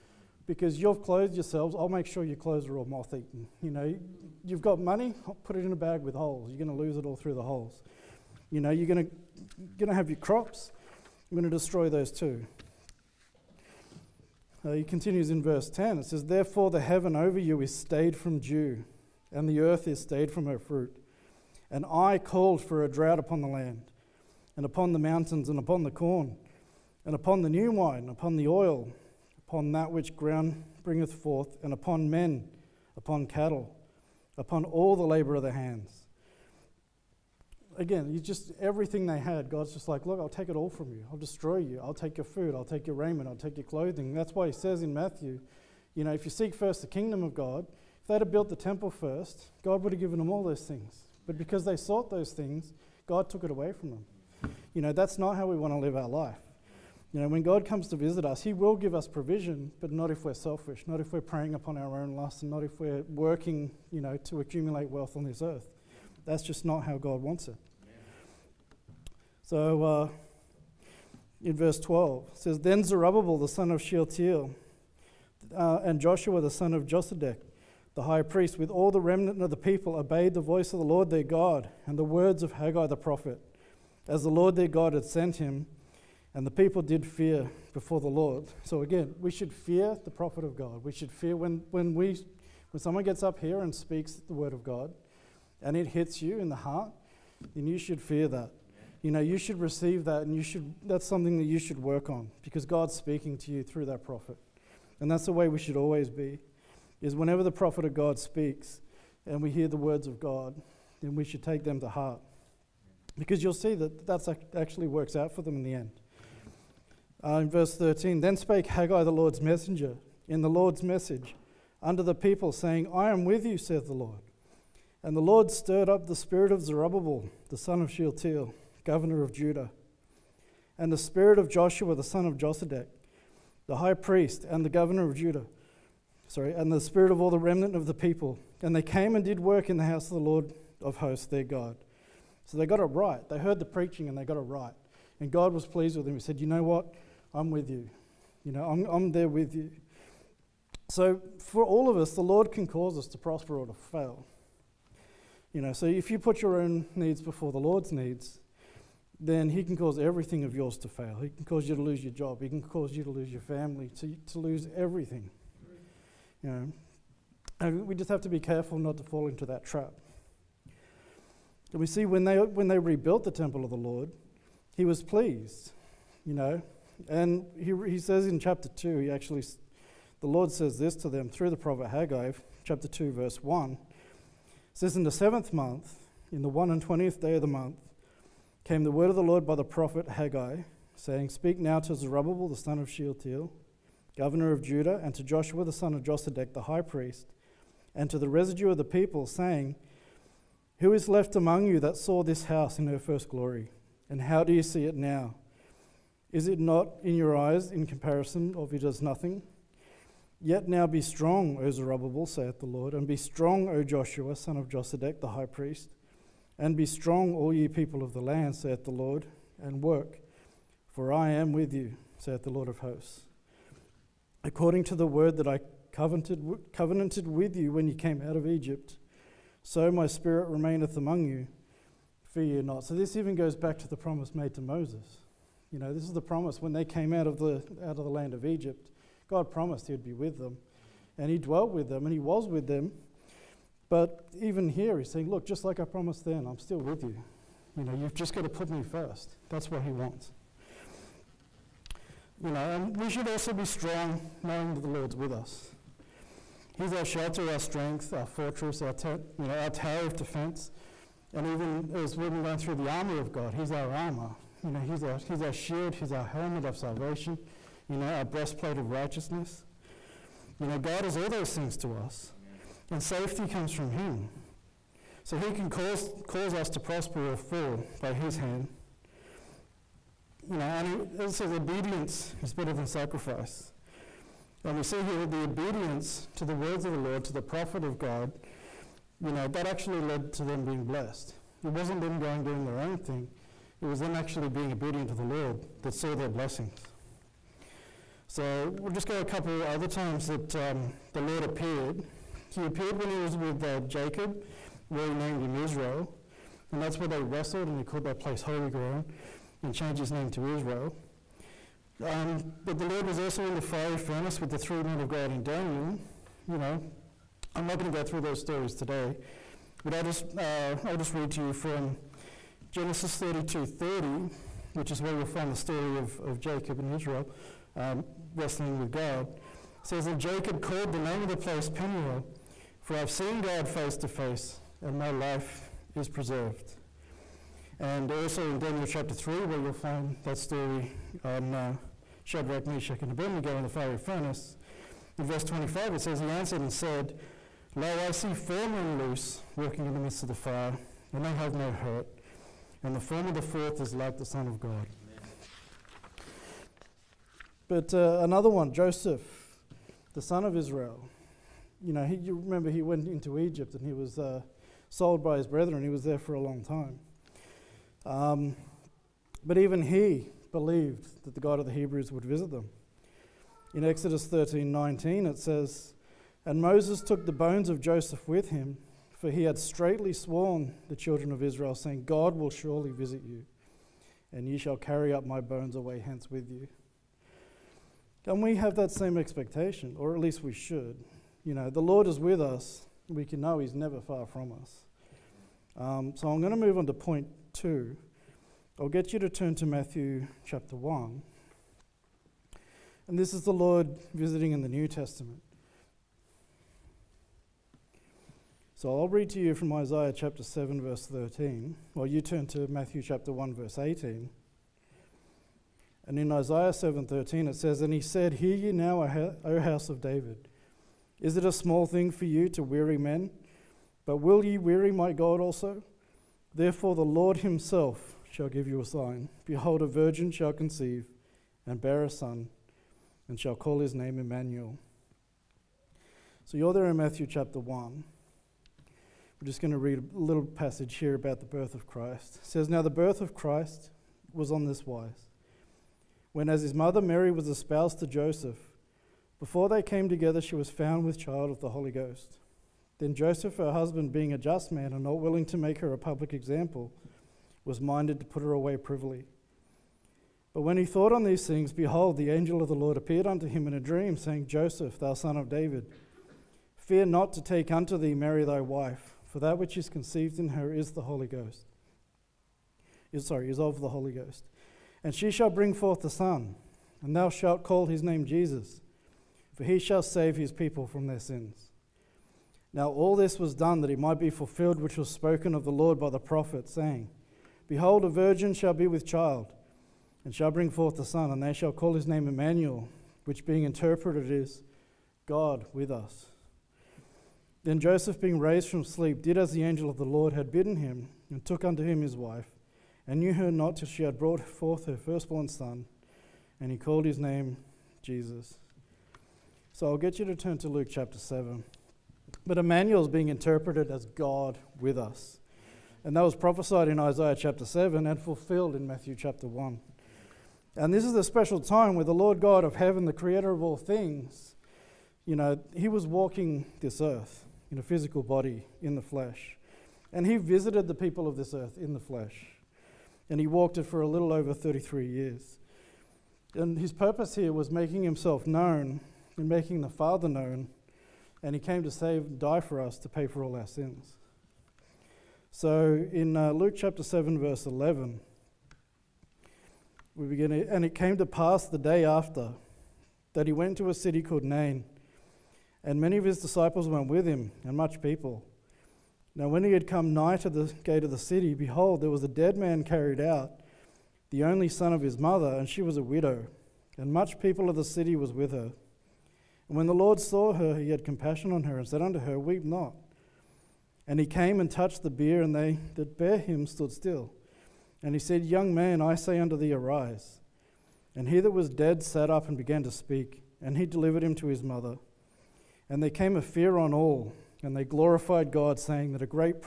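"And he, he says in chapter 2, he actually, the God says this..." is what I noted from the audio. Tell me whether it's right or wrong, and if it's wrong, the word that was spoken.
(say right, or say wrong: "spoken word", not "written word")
wrong: "Lord", not "God".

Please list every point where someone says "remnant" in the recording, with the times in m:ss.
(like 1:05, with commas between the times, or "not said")
1:19, 2:17.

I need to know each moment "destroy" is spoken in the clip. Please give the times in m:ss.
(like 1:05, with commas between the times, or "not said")
0:11, 0:41.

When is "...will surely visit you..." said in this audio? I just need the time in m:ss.
6:22.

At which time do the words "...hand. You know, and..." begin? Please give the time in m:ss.
4:38.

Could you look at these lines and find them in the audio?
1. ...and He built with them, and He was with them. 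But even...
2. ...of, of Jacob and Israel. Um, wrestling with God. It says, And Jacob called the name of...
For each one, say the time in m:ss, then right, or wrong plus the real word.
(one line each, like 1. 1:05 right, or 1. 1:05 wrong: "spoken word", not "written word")
1. 4:01 wrong: "dwelt", not "built"
2. 5:25 right.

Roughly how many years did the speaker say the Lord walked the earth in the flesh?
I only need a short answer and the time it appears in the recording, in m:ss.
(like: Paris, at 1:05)
A little over 33, at 8:54.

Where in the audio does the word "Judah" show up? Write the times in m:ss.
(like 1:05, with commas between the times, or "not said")
2:09, 2:15, 3:14.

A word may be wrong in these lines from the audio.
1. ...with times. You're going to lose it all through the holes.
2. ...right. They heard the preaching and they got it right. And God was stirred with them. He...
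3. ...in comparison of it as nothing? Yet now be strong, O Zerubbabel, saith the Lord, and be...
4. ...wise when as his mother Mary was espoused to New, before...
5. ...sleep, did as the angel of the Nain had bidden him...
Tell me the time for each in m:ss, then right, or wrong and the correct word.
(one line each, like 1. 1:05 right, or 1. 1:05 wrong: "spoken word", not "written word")
1. 0:06 wrong: "holes", not "times"
2. 2:22 wrong: "pleased", not "stirred"
3. 3:27 right
4. 7:24 wrong: "Joseph", not "New"
5. 8:18 wrong: "Lord", not "Nain".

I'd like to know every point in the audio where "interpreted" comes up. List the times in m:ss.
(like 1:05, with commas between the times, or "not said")
8:13, 8:33.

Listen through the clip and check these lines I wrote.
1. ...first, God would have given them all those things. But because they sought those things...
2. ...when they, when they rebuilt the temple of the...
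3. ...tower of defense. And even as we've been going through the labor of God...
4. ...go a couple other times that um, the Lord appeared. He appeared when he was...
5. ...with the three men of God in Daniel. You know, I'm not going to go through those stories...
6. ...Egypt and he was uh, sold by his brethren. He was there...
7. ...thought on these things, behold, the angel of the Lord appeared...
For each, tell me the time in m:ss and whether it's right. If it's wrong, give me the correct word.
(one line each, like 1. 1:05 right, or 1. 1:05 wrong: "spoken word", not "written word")
1. 0:48 right
2. 2:52 right
3. 4:19 wrong: "armor", not "labor"
4. 4:59 right
5. 5:14 right
6. 6:03 right
7. 7:40 right.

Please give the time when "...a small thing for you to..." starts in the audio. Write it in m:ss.
7:01.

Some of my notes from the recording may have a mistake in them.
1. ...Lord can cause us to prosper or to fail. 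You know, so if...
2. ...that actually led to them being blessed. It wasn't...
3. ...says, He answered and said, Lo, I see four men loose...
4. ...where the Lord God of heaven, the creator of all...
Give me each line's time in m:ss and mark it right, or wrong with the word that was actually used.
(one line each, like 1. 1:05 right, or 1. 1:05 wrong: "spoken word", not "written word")
1. 2:32 right
2. 4:49 right
3. 5:46 right
4. 8:41 right.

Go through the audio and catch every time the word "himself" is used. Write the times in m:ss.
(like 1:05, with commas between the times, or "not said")
7:07, 8:58.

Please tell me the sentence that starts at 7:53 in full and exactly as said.
Is, sorry, is of the Holy Ghost.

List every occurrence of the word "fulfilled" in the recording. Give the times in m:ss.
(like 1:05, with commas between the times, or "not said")
8:04, 8:38.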